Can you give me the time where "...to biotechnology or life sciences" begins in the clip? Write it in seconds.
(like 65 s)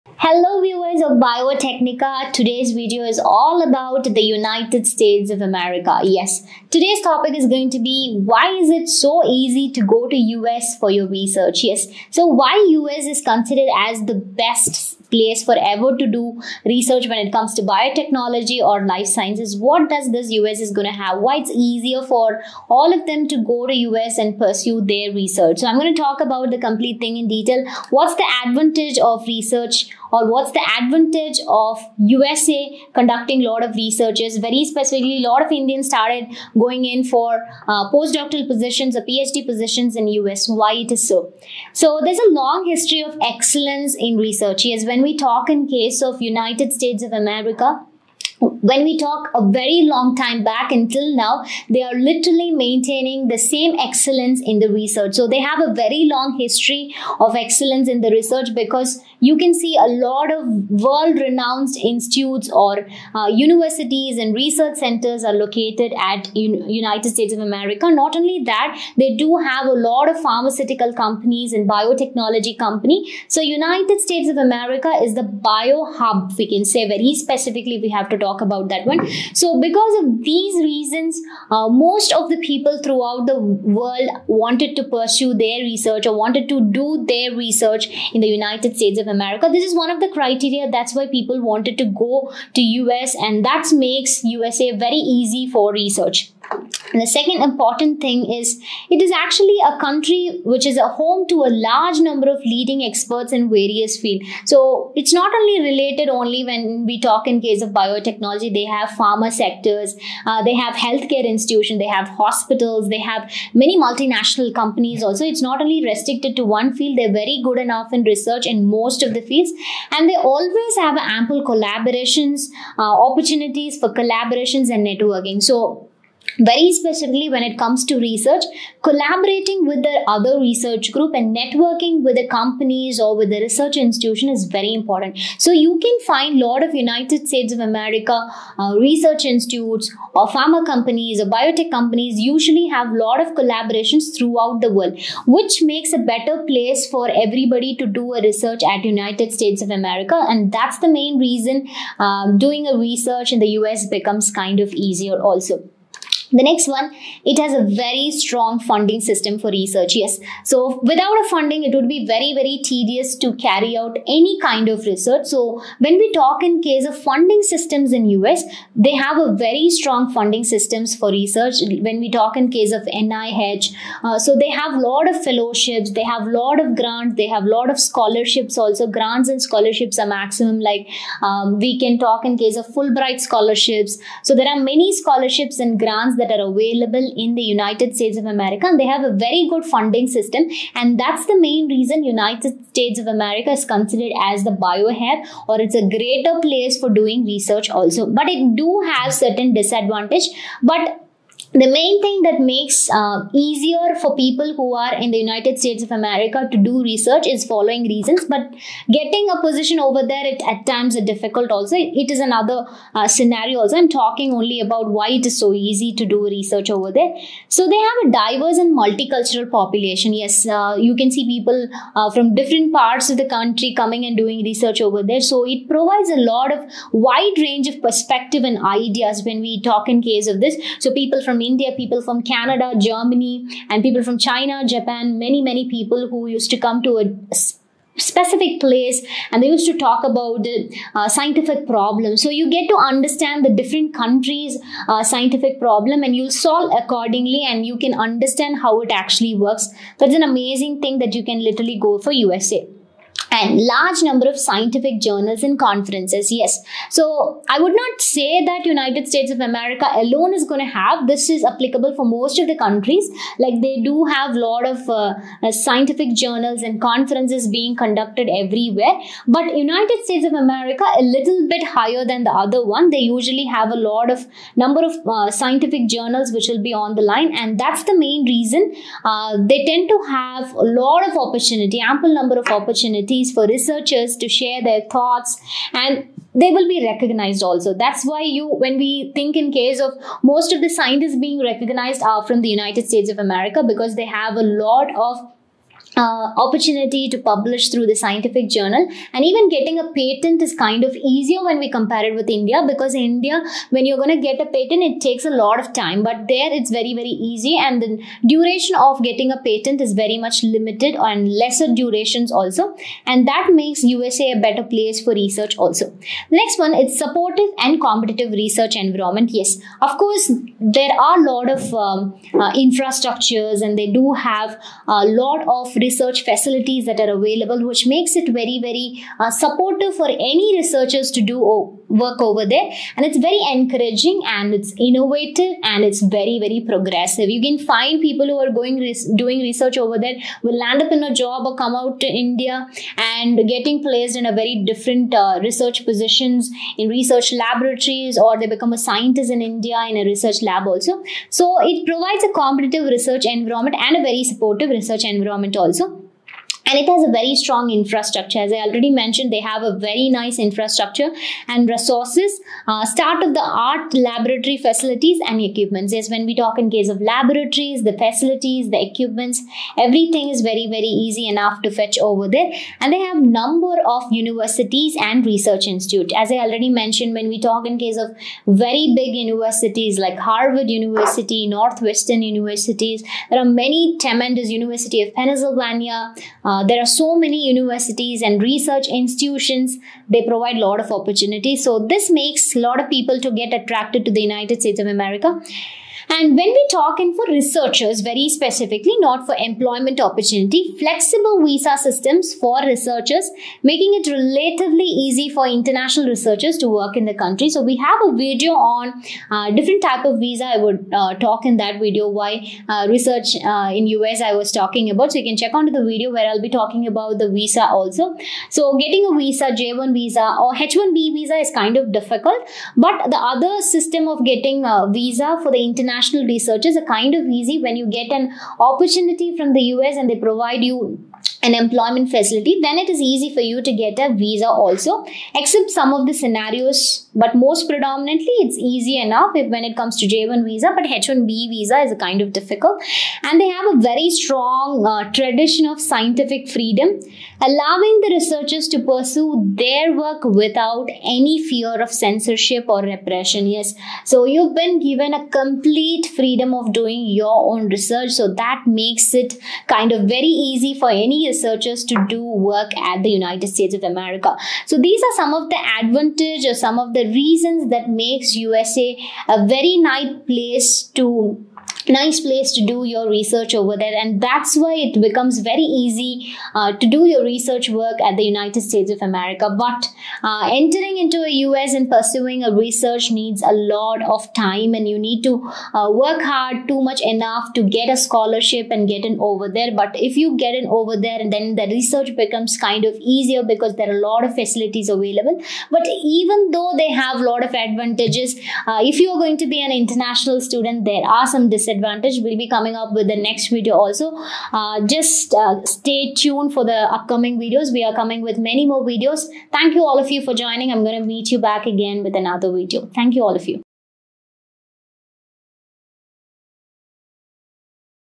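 17 s.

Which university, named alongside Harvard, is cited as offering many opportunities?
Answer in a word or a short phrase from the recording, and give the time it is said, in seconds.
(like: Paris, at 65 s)
University of Pennsylvania, at 384 s.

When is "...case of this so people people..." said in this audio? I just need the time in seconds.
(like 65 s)
230 s.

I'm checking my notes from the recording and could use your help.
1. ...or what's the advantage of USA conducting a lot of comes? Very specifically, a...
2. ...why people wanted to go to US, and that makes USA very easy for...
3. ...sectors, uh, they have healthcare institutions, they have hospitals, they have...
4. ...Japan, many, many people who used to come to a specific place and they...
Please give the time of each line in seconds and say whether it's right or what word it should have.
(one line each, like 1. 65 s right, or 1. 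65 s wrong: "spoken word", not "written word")
1. 30 s wrong: "researches", not "comes"
2. 90 s right
3. 109 s right
4. 234 s right.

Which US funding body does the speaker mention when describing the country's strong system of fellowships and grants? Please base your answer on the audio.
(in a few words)
NIH.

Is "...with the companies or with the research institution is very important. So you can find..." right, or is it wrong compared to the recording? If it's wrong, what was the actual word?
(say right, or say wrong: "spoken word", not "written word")
right.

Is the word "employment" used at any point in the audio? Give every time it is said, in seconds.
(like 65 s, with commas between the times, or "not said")
399 s, 431 s.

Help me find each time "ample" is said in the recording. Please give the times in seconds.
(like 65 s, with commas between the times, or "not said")
120 s, 281 s.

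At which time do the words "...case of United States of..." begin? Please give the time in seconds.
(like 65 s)
45 s.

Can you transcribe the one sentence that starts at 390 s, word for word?
They provide a lot of opportunities.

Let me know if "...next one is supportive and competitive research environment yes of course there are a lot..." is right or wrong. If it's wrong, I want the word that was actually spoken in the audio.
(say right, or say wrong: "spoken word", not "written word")
right.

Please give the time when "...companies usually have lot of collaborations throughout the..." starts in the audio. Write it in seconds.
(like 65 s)
141 s.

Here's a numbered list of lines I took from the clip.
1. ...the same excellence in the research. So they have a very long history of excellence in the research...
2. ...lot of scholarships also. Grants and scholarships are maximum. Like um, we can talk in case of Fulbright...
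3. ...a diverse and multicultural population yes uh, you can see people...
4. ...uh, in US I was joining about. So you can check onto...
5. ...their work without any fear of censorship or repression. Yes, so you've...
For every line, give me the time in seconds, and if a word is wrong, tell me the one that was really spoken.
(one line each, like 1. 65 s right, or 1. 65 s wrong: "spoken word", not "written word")
1. 53 s right
2. 177 s right
3. 218 s right
4. 413 s wrong: "talking", not "joining"
5. 449 s right.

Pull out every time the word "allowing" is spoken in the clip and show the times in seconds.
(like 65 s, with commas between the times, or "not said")
447 s.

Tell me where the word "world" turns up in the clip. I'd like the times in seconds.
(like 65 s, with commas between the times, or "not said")
60 s, 83 s, 144 s.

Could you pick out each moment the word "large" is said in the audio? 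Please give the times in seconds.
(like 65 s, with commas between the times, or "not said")
101 s, 253 s.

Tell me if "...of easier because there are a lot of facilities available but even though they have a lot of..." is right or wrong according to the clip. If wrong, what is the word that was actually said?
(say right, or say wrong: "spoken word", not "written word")
right.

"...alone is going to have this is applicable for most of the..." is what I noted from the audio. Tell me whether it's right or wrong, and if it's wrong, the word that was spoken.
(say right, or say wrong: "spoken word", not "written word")
right.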